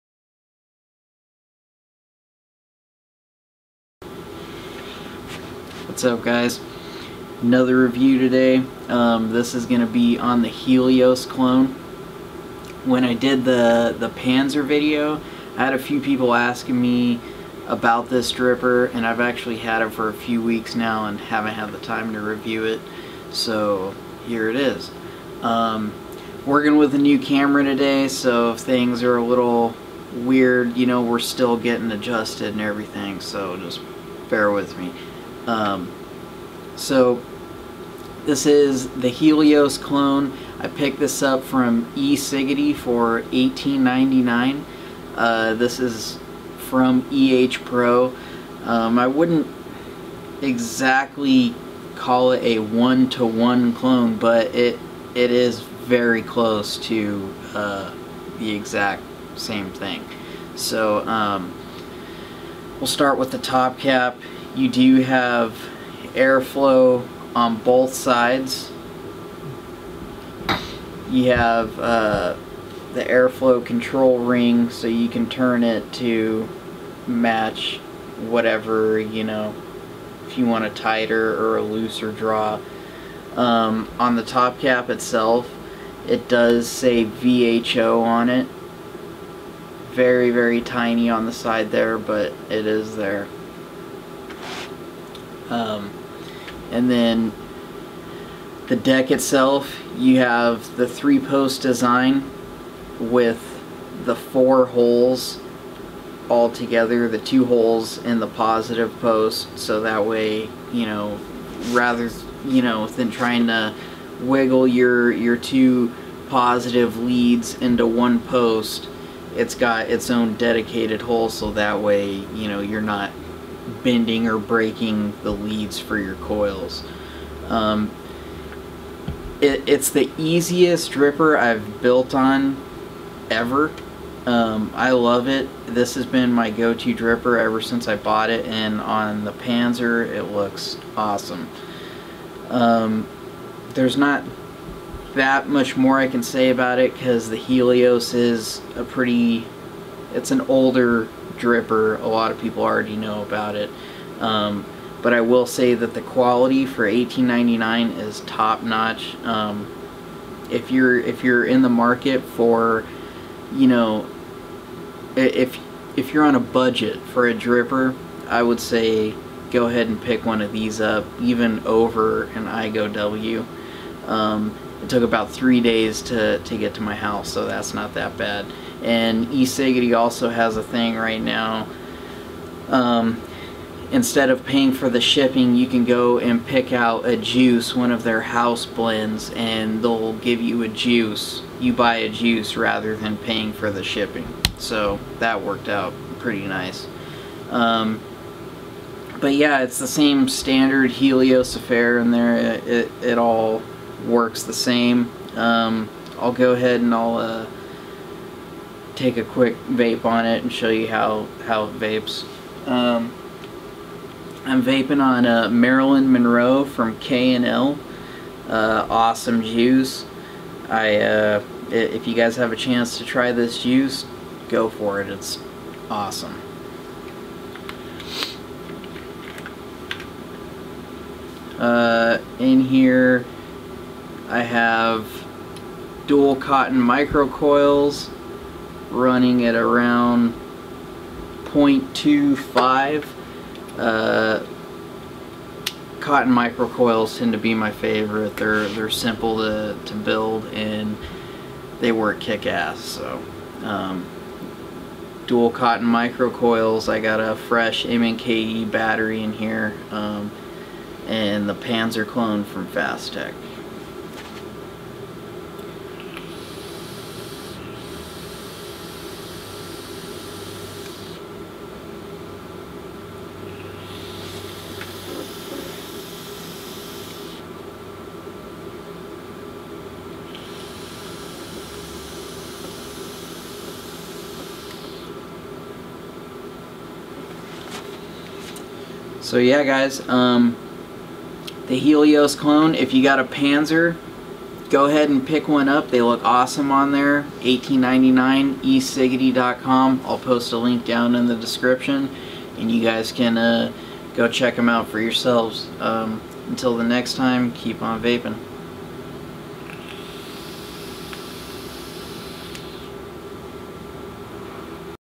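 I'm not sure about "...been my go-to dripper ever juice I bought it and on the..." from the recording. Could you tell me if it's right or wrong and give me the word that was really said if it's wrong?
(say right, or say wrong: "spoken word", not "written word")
wrong: "since", not "juice".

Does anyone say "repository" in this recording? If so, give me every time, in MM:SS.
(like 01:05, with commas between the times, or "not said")
not said.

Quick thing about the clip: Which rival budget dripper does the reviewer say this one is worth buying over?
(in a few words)
IGO W.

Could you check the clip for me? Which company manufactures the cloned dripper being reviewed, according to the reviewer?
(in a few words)
EH Pro.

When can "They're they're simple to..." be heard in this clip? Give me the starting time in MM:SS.
04:08.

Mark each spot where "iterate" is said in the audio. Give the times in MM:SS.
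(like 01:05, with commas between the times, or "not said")
not said.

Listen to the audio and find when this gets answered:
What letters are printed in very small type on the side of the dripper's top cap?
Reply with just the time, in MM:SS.
01:27.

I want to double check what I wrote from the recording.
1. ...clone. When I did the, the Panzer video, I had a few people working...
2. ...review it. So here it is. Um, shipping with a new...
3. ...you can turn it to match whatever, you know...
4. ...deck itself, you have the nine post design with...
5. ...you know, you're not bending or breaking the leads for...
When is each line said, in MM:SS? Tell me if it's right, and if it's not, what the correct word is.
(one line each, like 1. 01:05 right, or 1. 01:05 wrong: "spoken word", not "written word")
1. 00:11 wrong: "asking", not "working"
2. 00:22 wrong: "working", not "shipping"
3. 01:14 right
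4. 01:38 wrong: "three", not "nine"
5. 02:02 right.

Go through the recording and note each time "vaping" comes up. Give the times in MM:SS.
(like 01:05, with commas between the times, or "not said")
03:34, 05:08.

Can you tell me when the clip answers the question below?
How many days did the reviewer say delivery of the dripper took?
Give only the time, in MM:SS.
02:55.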